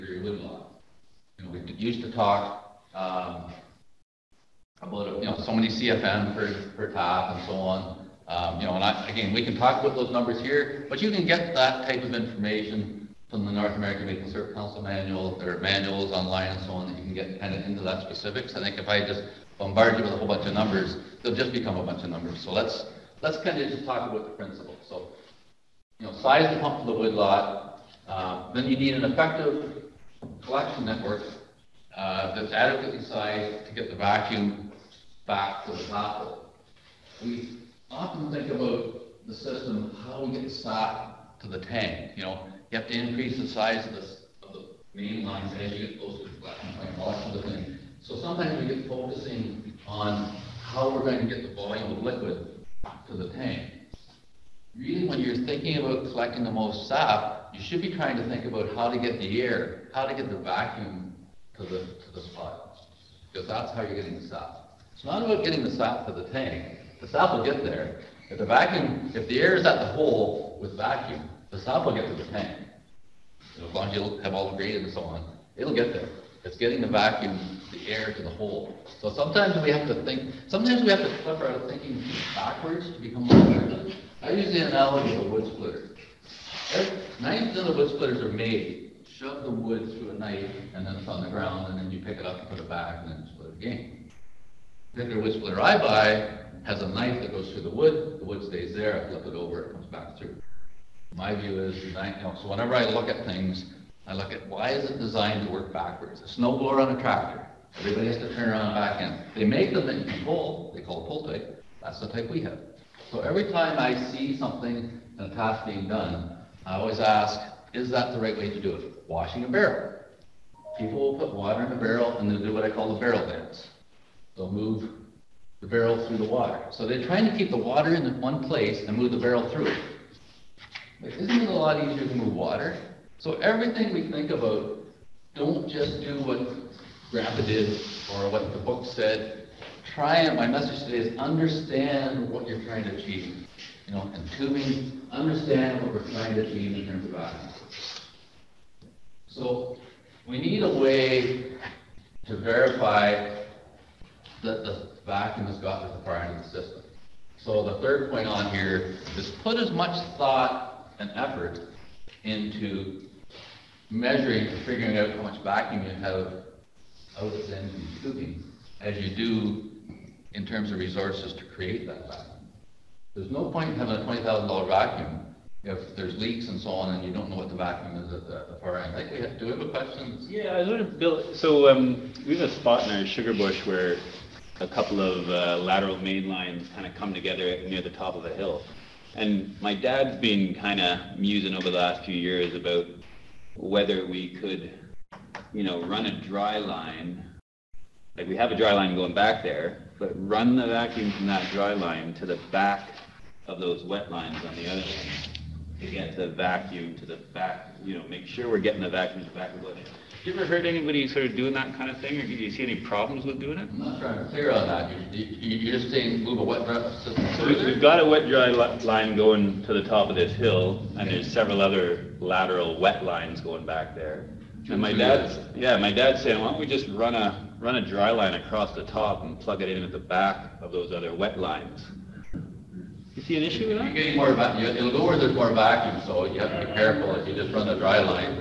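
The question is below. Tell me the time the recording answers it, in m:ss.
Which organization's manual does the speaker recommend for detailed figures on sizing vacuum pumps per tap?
0:13.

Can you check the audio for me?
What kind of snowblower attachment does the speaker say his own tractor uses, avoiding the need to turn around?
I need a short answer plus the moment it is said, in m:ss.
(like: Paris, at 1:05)
pull type, at 1:51.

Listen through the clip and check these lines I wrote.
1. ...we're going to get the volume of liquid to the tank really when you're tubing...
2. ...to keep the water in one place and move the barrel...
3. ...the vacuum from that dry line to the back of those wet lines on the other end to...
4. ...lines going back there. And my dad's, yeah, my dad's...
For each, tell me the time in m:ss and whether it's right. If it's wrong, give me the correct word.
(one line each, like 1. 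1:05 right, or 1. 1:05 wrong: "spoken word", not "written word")
1. 0:50 wrong: "thinking", not "tubing"
2. 2:07 right
3. 3:20 right
4. 3:43 right.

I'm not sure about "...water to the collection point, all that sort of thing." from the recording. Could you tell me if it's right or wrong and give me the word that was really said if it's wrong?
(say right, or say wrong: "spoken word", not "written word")
wrong: "closer", not "water".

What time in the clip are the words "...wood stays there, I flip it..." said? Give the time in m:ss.
1:38.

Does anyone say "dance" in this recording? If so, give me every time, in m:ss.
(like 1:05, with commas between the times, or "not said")
2:03.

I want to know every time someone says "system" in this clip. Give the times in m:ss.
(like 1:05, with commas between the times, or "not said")
0:39, 2:36.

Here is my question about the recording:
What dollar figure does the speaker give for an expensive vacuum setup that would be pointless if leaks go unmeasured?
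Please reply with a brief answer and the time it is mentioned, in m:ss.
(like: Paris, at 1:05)
$20,000, at 2:53.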